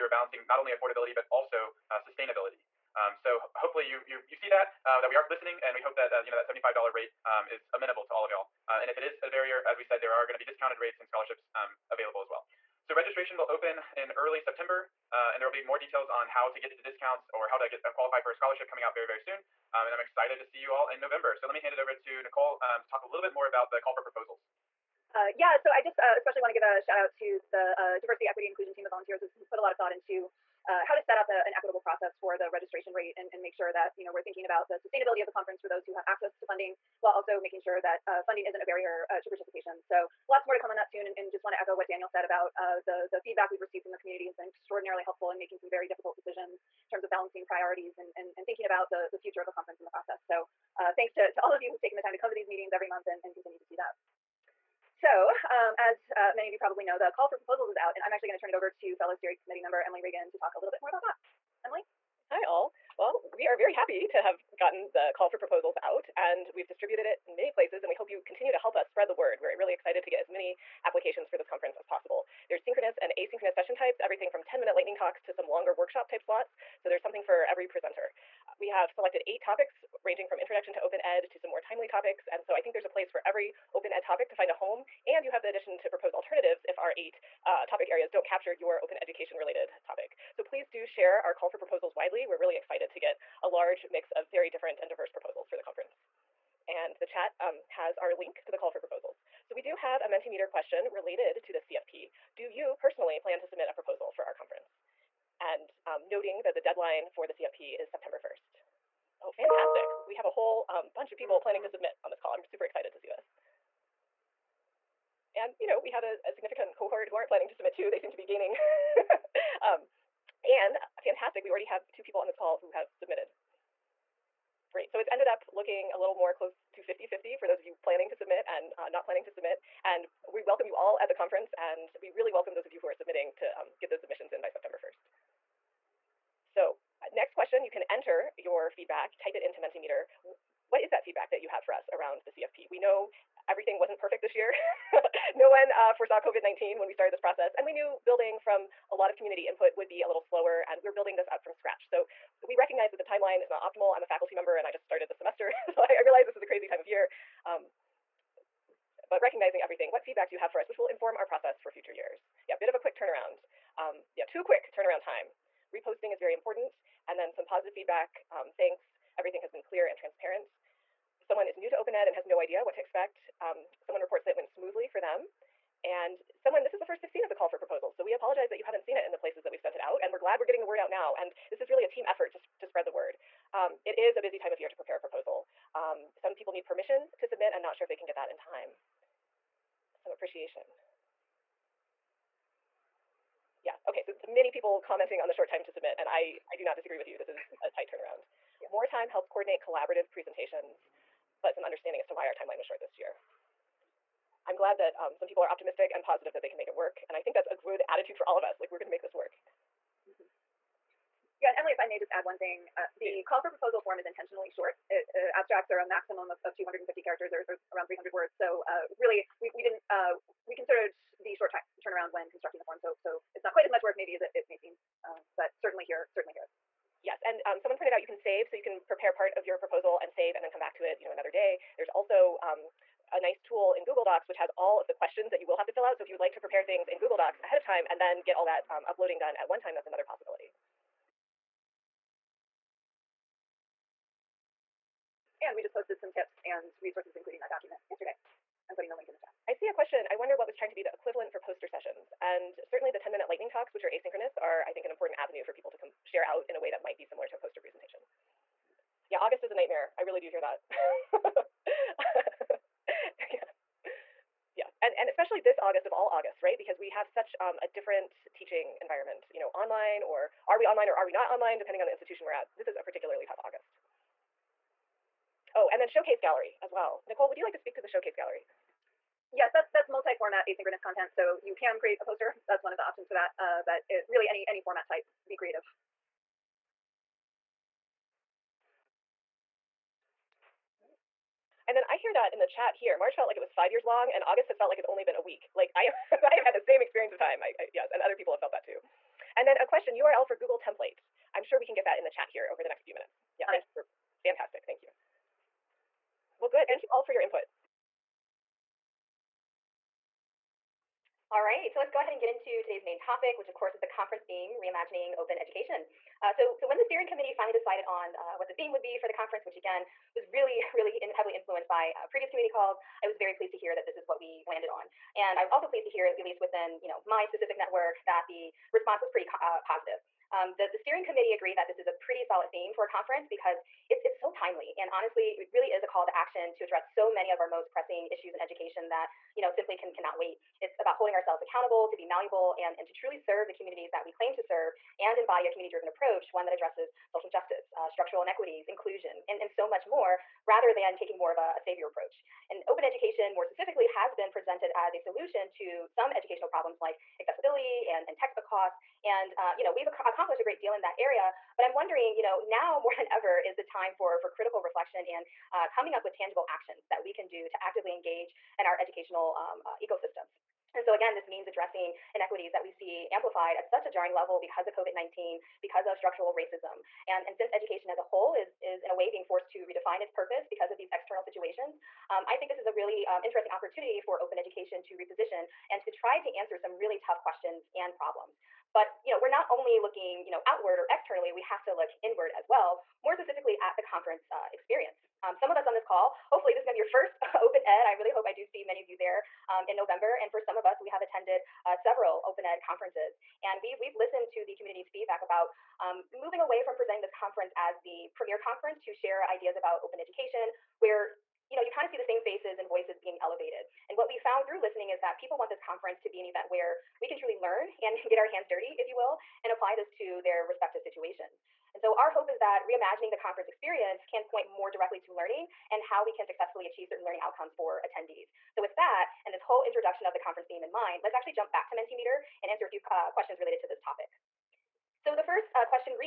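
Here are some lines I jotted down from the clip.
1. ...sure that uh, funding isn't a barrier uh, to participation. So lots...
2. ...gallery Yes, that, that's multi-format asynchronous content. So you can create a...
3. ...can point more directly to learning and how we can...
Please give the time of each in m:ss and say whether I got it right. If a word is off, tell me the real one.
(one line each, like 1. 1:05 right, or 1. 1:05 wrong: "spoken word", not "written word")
1. 0:37 right
2. 4:38 right
3. 7:04 right.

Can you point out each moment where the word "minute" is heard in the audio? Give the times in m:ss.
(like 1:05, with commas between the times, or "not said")
1:14, 4:13, 5:02.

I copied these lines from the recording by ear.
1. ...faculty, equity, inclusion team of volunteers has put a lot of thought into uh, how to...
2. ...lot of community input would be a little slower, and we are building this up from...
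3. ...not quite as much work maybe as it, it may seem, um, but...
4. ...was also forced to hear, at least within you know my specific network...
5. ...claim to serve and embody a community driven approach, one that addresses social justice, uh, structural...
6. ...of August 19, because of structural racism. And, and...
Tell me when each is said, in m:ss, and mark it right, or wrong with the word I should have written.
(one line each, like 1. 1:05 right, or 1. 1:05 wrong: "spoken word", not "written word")
1. 0:28 wrong: "diversity", not "faculty"
2. 2:28 right
3. 3:43 right
4. 5:25 wrong: "pleased", not "forced"
5. 5:44 right
6. 6:14 wrong: "COVID", not "August".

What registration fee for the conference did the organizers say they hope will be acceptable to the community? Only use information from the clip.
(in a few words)
$75.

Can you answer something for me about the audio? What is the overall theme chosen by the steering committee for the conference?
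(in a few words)
Reimagining Open Education.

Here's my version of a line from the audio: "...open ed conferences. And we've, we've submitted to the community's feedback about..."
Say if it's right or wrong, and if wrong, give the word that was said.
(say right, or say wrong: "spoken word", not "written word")
wrong: "listened", not "submitted".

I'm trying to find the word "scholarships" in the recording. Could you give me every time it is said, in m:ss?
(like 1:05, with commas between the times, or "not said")
0:11, 0:18.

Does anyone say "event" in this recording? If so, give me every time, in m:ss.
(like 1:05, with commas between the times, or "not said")
6:56.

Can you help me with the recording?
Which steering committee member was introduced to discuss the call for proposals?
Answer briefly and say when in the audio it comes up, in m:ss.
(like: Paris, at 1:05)
Emily Ragan, at 0:59.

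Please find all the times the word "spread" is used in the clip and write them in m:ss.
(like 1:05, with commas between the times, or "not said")
1:08, 3:02.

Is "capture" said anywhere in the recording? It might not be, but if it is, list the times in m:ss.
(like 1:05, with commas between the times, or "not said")
1:28.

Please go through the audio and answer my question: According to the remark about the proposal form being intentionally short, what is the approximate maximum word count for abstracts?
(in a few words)
300 words.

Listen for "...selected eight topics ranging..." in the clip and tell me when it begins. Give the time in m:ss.
1:18.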